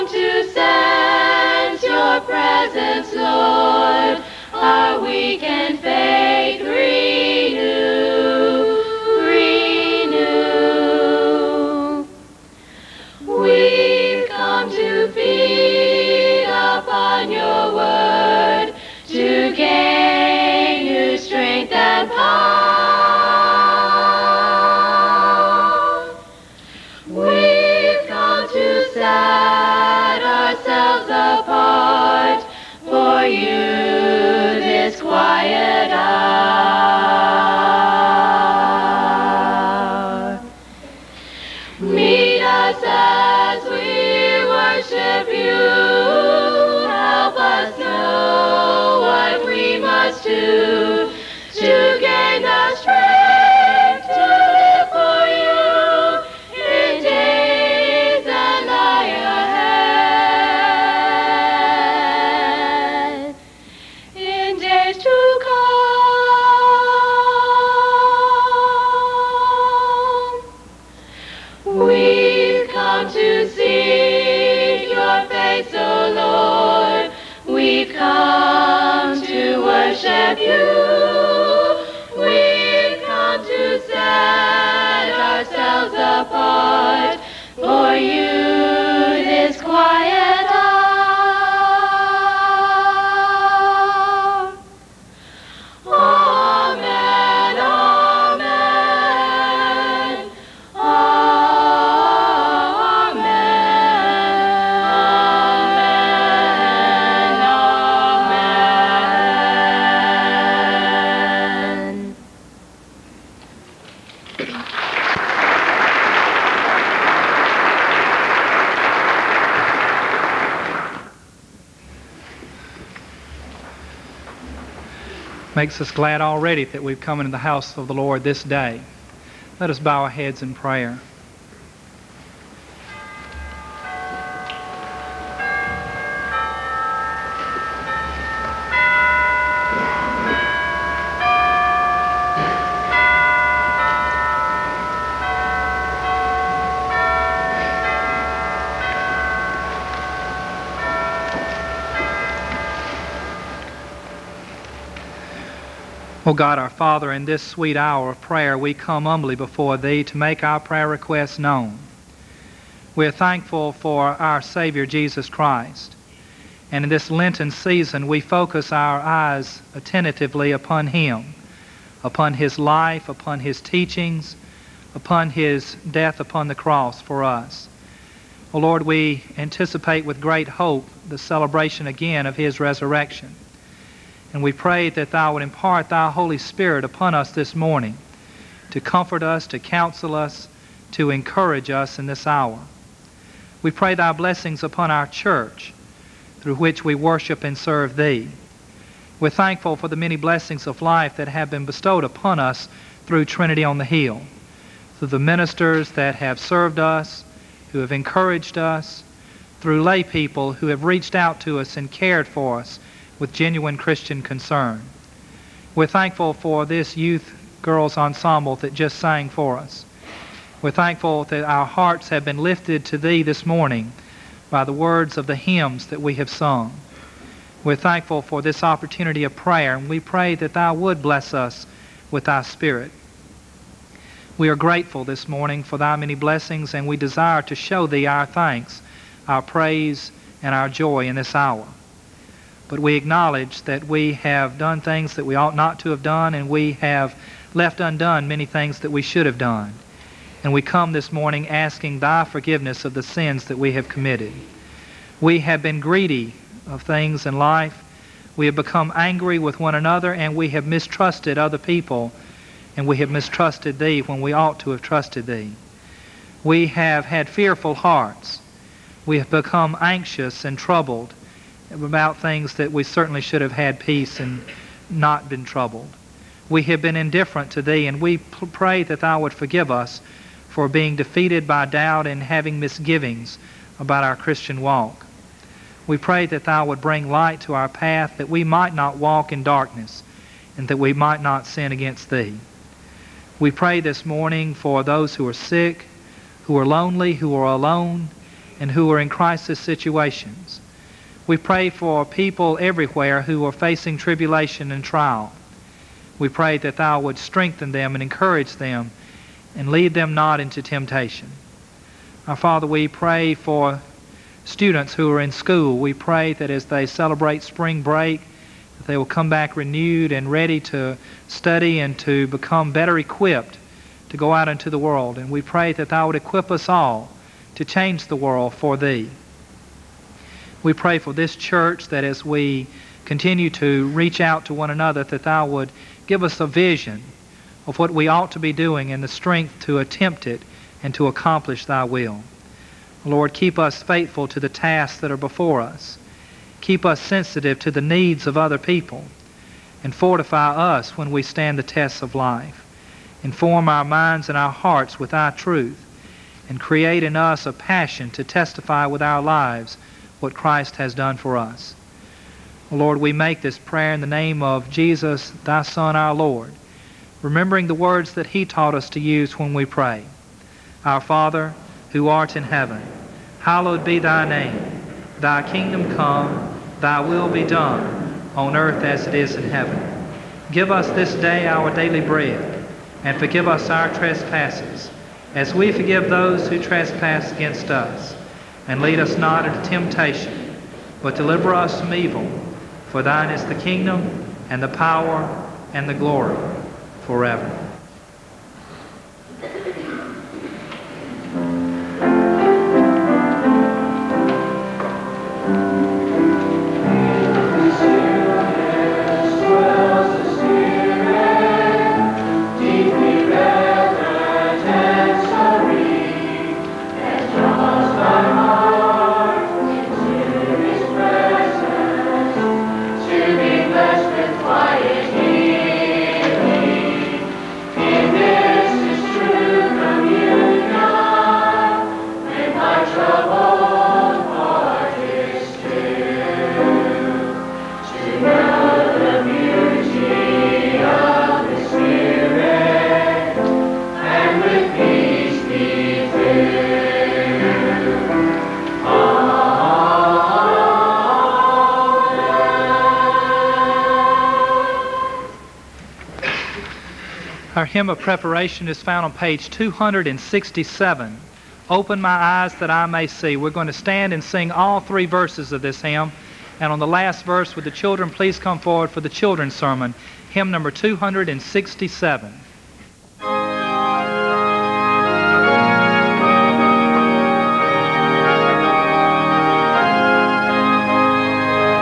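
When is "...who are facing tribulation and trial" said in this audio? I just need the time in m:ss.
5:03.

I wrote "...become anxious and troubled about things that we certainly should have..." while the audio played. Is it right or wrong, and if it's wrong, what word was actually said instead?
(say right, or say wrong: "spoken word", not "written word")
right.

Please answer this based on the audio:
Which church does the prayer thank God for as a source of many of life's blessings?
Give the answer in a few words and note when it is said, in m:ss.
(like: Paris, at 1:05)
Trinity on the Hill, at 3:23.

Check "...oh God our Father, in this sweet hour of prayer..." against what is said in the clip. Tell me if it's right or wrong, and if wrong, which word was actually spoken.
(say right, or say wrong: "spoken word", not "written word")
right.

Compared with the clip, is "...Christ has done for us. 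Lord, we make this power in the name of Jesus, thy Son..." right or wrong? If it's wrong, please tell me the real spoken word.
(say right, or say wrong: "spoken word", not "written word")
wrong: "prayer", not "power".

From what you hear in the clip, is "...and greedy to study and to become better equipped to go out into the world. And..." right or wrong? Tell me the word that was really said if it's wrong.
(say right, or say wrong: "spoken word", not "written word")
wrong: "ready", not "greedy".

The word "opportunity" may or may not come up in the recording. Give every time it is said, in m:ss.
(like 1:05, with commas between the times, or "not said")
3:48.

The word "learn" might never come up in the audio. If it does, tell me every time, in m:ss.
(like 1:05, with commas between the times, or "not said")
not said.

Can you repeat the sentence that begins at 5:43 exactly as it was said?
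Lord, keep us faithful to the tasks that are before us.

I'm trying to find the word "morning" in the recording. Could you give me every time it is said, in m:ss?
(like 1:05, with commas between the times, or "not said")
3:07, 3:43, 3:55, 4:11, 4:54.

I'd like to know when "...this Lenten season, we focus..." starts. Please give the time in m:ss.
2:46.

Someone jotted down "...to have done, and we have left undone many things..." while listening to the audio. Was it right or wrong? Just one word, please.
right.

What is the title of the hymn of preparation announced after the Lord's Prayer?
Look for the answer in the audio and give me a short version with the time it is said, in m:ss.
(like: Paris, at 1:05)
Open My Eyes That I May See, at 7:41.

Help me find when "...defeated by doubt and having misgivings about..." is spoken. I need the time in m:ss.
4:40.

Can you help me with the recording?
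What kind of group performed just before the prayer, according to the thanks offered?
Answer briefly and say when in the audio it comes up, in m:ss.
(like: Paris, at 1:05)
Youth girls ensemble, at 3:36.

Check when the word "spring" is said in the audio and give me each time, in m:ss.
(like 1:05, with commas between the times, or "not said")
5:17.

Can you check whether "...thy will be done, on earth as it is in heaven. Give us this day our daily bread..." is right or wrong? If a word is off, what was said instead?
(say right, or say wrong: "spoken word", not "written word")
right.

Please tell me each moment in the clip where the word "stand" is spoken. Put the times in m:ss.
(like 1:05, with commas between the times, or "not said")
5:51, 7:43.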